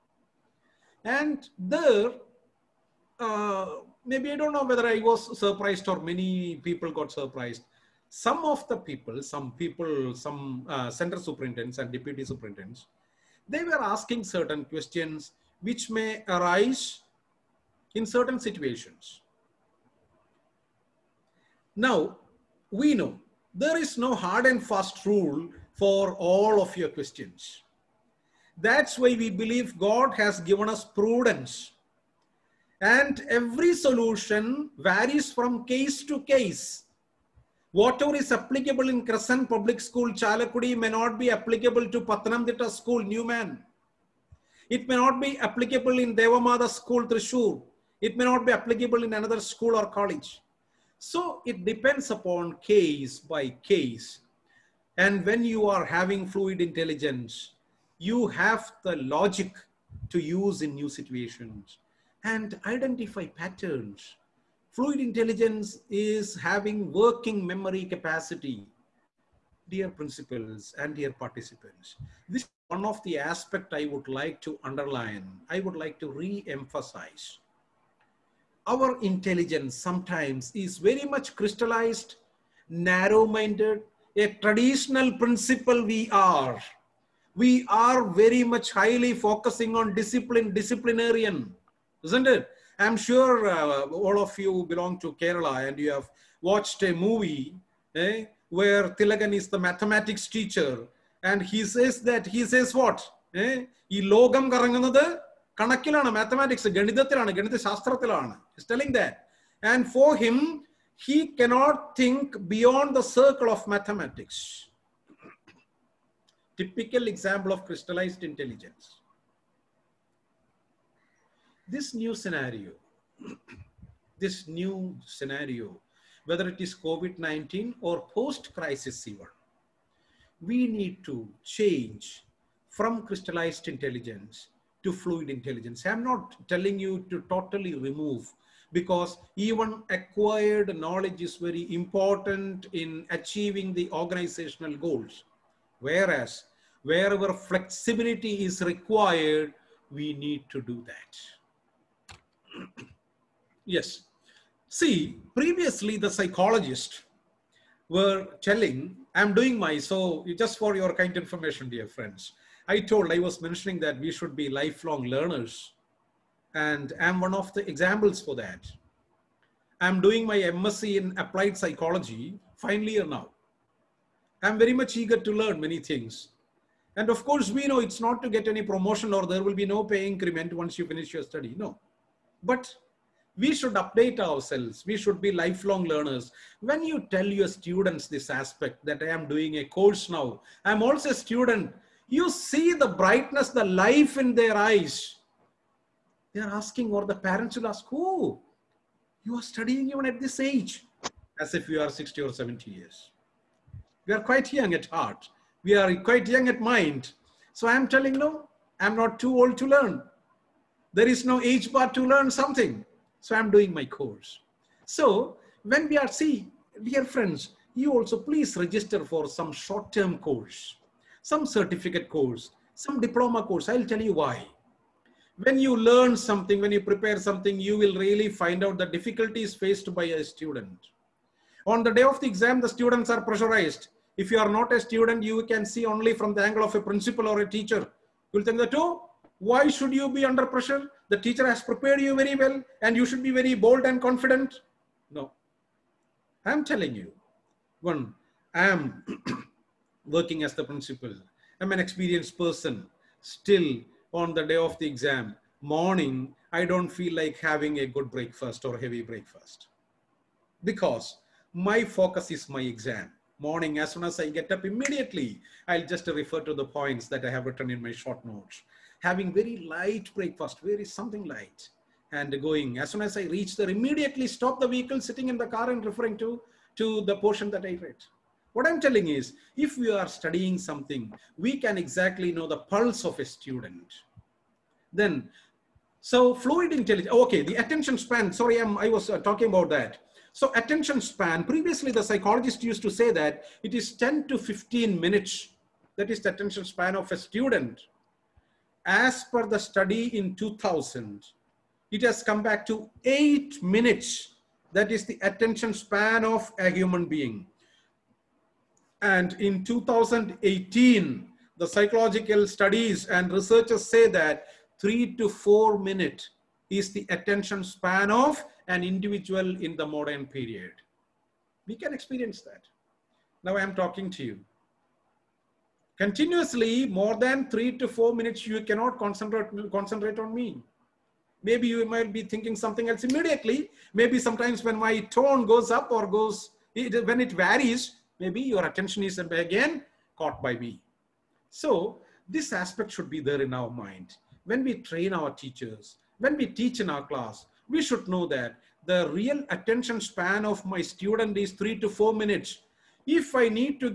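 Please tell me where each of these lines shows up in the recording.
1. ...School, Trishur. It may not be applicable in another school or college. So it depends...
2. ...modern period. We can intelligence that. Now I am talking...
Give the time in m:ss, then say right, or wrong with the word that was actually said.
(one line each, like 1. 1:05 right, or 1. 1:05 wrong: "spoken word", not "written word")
1. 0:46 right
2. 5:19 wrong: "experience", not "intelligence".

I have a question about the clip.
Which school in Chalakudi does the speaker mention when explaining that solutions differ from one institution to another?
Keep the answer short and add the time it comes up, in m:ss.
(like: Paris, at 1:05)
Crescent Public School, at 0:39.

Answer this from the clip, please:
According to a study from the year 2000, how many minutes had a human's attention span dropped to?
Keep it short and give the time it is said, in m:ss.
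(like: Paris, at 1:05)
8 minutes, at 5:03.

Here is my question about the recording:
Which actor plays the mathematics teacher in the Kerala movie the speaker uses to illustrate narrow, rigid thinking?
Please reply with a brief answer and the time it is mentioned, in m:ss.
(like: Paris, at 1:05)
Thilakan, at 1:38.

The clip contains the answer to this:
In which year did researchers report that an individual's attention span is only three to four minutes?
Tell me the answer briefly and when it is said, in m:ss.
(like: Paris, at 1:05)
2018, at 5:09.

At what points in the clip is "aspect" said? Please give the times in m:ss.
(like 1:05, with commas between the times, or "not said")
1:13, 3:08, 5:42.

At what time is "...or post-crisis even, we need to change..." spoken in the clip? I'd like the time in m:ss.
2:07.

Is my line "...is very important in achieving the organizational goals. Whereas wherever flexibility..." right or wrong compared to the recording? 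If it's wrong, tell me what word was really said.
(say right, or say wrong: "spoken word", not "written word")
right.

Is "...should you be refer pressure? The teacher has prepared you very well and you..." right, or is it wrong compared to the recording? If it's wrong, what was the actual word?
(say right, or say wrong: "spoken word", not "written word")
wrong: "under", not "refer".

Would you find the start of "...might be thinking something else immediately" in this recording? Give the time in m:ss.
5:31.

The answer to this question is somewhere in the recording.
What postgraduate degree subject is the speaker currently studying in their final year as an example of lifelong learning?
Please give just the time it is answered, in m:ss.
2:51.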